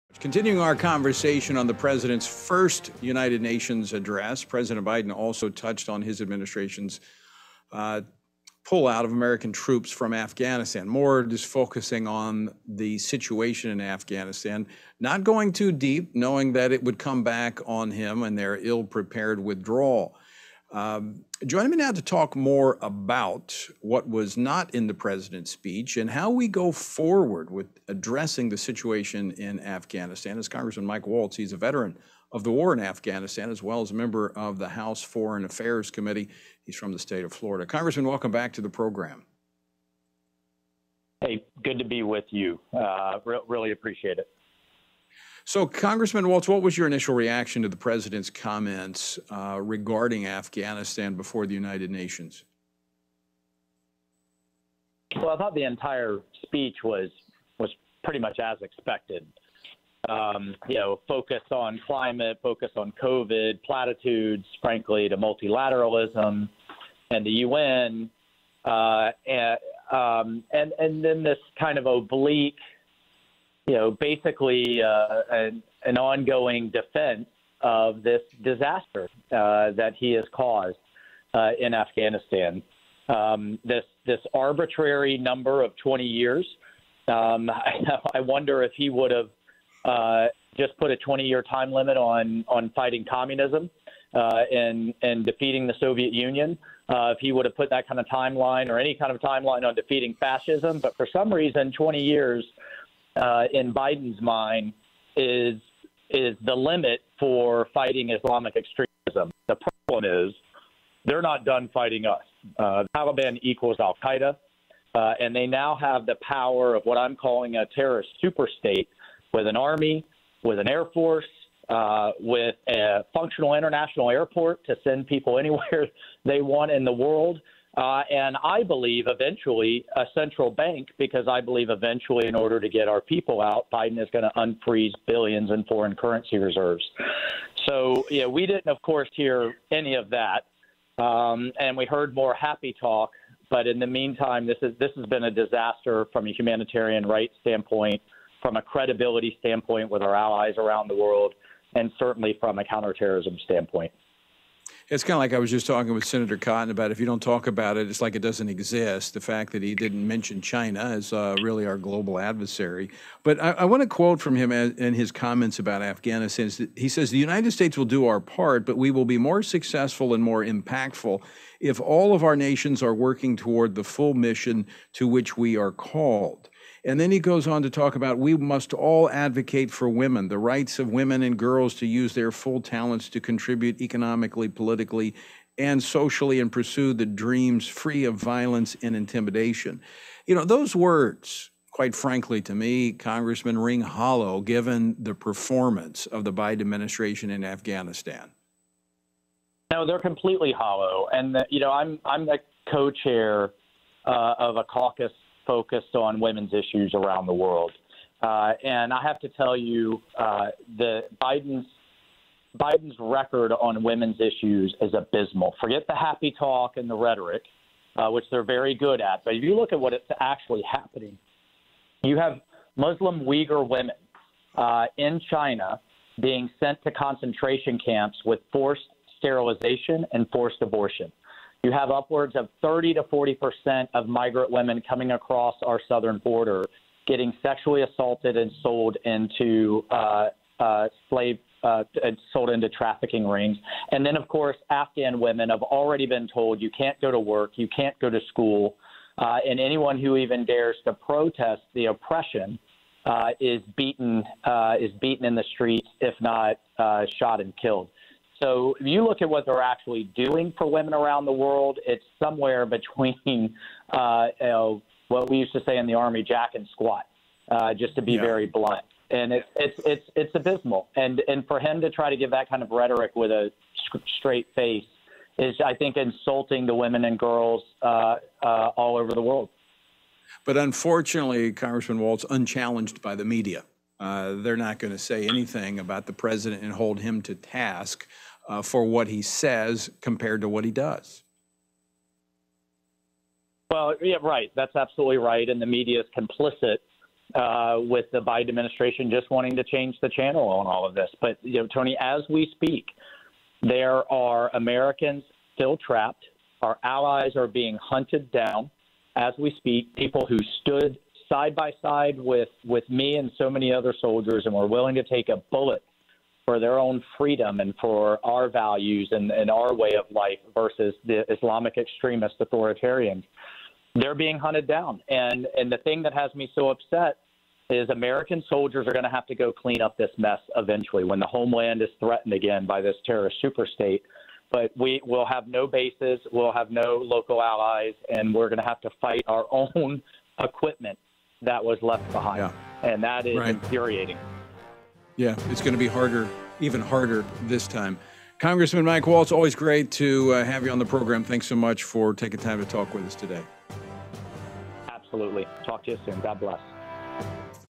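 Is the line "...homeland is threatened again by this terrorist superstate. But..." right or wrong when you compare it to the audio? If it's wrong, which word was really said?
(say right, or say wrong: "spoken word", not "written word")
right.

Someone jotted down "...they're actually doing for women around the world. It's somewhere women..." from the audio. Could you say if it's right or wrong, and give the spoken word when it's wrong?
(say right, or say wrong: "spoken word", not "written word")
wrong: "between", not "women".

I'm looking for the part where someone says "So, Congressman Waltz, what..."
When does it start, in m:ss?
0:45.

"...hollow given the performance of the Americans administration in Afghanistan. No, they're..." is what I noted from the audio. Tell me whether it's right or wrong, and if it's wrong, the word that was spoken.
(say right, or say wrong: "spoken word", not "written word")
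wrong: "Biden", not "Americans".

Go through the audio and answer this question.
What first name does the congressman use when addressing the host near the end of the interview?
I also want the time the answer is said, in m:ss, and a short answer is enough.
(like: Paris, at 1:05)
Tony, at 5:01.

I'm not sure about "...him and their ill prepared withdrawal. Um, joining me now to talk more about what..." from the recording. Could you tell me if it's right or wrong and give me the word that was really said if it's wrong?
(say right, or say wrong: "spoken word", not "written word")
right.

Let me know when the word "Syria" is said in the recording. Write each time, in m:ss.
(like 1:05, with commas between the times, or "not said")
not said.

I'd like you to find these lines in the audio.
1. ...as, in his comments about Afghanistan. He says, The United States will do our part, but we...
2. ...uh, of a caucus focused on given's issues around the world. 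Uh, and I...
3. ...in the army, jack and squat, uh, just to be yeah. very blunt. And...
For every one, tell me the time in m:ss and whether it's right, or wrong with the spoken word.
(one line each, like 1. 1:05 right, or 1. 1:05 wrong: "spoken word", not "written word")
1. 2:44 right
2. 3:24 wrong: "women", not "given"
3. 4:25 right.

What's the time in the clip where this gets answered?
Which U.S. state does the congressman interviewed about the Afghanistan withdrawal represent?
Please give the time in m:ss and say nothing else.
0:37.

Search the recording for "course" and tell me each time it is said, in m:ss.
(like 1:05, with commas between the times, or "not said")
2:18, 4:04.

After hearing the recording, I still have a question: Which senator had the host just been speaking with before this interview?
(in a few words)
Senator Cotton.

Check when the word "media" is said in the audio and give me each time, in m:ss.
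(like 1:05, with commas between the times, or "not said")
4:43, 4:55.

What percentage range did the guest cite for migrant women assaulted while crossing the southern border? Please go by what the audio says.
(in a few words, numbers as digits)
30 to 40 percent.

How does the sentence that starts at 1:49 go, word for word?
The problem is they're not done fighting us.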